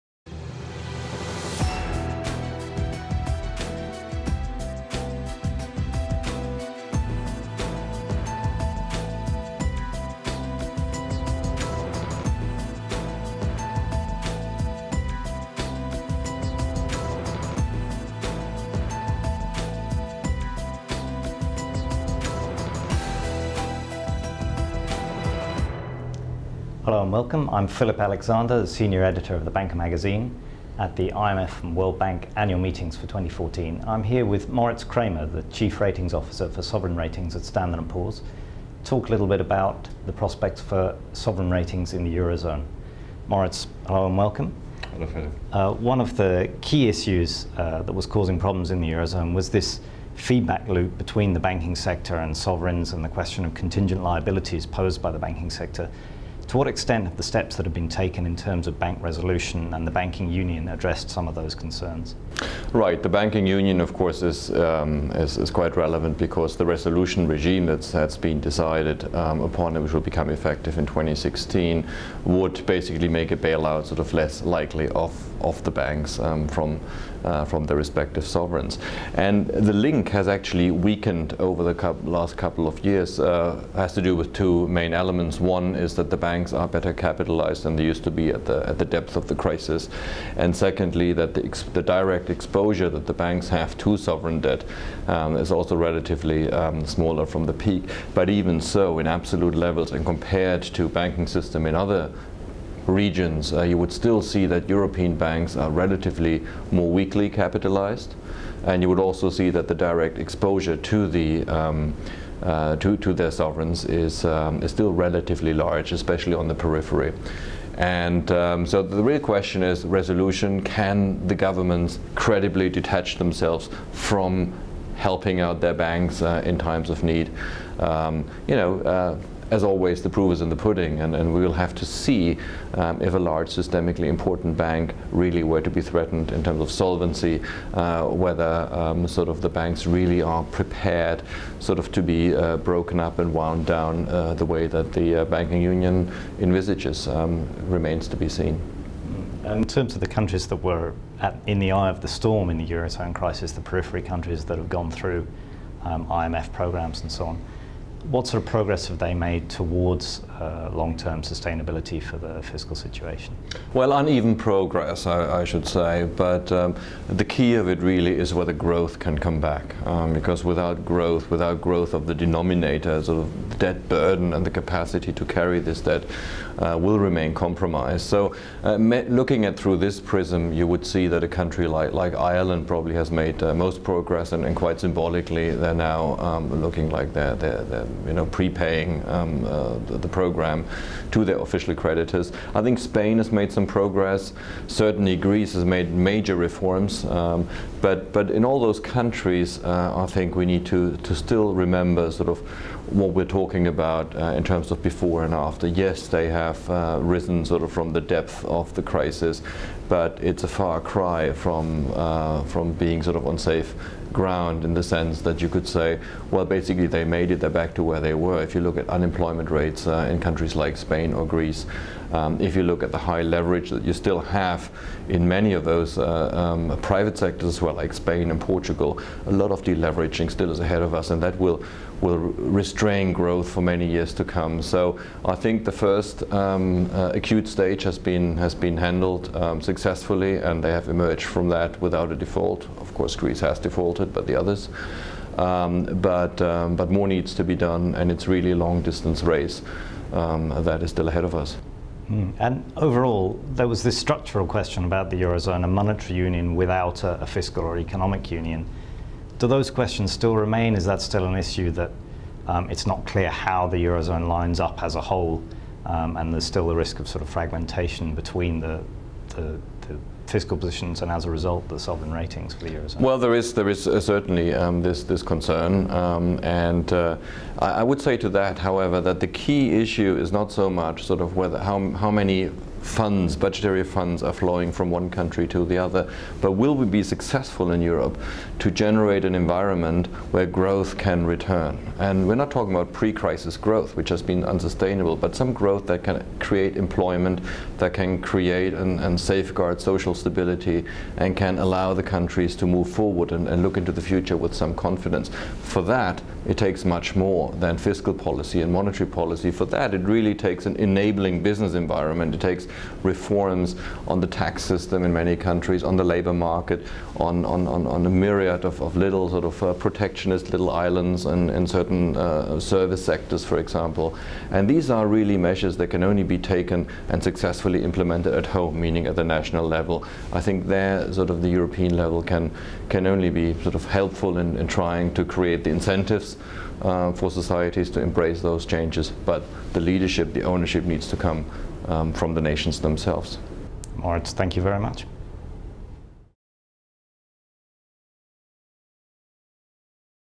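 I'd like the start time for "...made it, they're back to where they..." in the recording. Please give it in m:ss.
3:37.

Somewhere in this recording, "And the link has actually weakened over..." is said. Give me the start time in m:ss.
1:19.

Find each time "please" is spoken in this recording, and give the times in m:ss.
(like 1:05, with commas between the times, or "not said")
not said.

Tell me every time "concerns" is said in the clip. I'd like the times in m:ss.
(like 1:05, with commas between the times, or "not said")
1:01, 4:35.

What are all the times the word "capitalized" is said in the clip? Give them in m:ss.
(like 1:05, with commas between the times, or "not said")
1:26, 1:47.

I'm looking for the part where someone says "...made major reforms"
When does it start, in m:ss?
3:15.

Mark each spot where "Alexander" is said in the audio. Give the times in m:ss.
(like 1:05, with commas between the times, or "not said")
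0:28.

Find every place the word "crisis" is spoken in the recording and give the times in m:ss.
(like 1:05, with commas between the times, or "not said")
1:29, 2:33, 3:28, 4:52.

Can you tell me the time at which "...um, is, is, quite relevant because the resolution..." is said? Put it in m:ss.
1:04.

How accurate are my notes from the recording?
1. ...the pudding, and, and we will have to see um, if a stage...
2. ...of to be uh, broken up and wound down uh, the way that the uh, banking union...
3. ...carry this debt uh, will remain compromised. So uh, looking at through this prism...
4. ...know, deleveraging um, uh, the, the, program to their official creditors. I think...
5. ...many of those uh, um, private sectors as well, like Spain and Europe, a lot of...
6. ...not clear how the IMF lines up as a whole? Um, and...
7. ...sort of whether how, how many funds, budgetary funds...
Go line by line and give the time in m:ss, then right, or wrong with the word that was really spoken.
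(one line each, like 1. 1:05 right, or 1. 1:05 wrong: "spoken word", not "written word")
1. 2:10 wrong: "large", not "stage"
2. 2:21 right
3. 2:55 right
4. 3:08 wrong: "prepaying", not "deleveraging"
5. 3:45 wrong: "Portugal", not "Europe"
6. 4:22 wrong: "Eurozone", not "IMF"
7. 4:41 right.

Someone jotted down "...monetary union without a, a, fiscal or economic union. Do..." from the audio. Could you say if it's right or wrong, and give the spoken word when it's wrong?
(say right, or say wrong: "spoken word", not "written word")
right.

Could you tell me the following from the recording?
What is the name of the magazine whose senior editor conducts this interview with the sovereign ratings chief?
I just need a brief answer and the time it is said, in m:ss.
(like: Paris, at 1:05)
The Banker, at 0:29.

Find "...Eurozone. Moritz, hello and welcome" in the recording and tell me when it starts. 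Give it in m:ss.
0:42.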